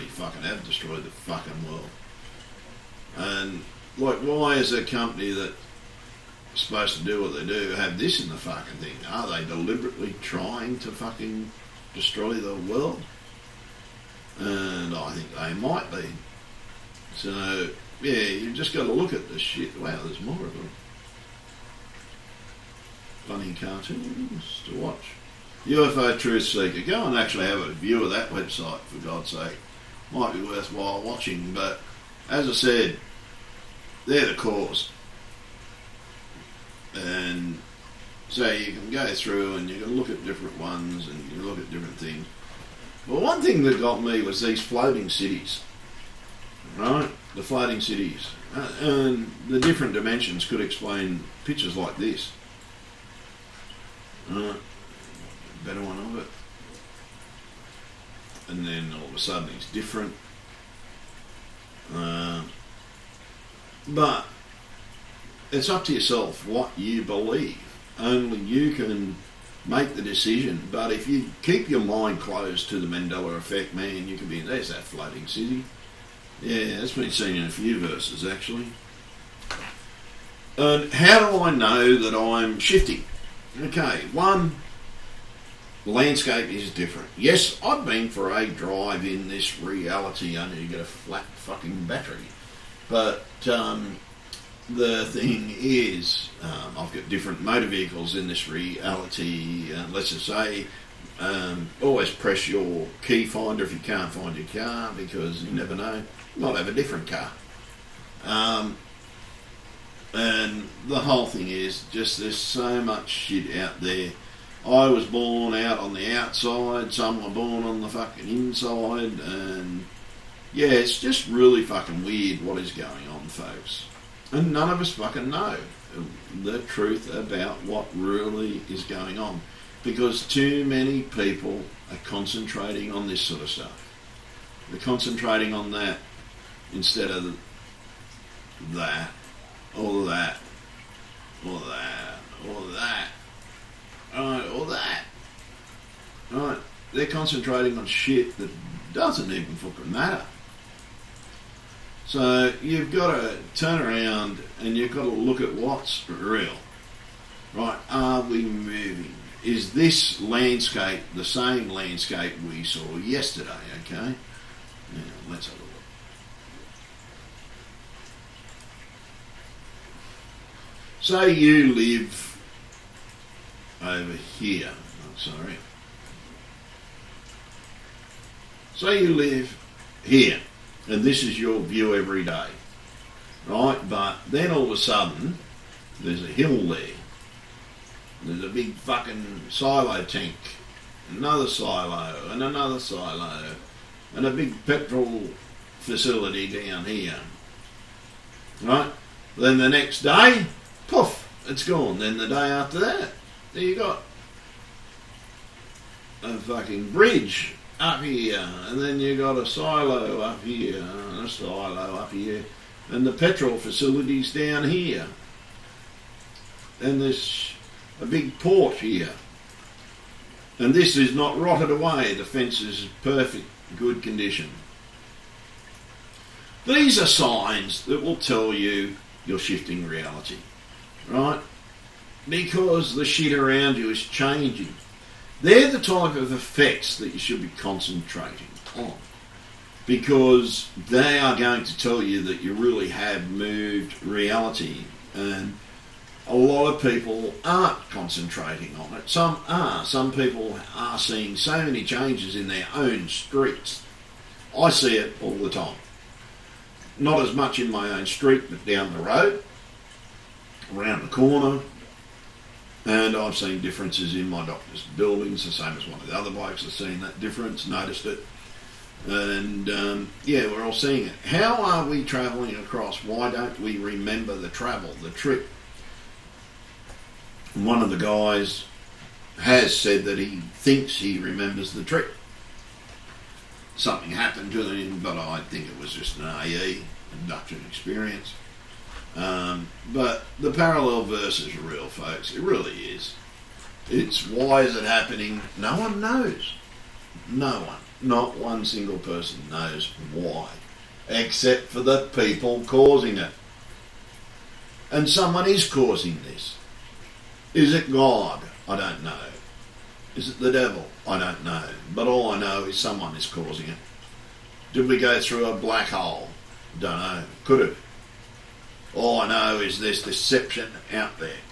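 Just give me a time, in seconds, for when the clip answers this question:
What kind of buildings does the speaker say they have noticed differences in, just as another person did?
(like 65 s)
264 s.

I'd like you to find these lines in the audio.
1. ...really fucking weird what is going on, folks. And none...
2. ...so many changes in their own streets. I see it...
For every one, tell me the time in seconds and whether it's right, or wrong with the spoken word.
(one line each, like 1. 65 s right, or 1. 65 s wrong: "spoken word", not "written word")
1. 121 s right
2. 251 s right.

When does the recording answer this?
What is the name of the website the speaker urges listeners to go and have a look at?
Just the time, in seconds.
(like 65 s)
25 s.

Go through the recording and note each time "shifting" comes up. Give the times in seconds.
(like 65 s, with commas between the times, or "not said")
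82 s, 229 s.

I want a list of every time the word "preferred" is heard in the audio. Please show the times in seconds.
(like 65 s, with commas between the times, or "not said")
not said.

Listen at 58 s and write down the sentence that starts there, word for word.
And then all of a sudden it's different.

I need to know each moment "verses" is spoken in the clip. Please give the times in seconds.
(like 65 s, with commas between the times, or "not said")
77 s, 291 s.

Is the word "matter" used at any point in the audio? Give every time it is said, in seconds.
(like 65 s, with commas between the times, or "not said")
149 s.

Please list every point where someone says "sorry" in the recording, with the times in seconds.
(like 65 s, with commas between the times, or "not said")
175 s.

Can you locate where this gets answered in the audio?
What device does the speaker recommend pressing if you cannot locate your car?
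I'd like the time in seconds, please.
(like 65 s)
103 s.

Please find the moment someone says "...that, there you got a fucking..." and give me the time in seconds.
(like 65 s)
202 s.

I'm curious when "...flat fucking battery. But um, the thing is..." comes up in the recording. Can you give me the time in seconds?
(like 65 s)
90 s.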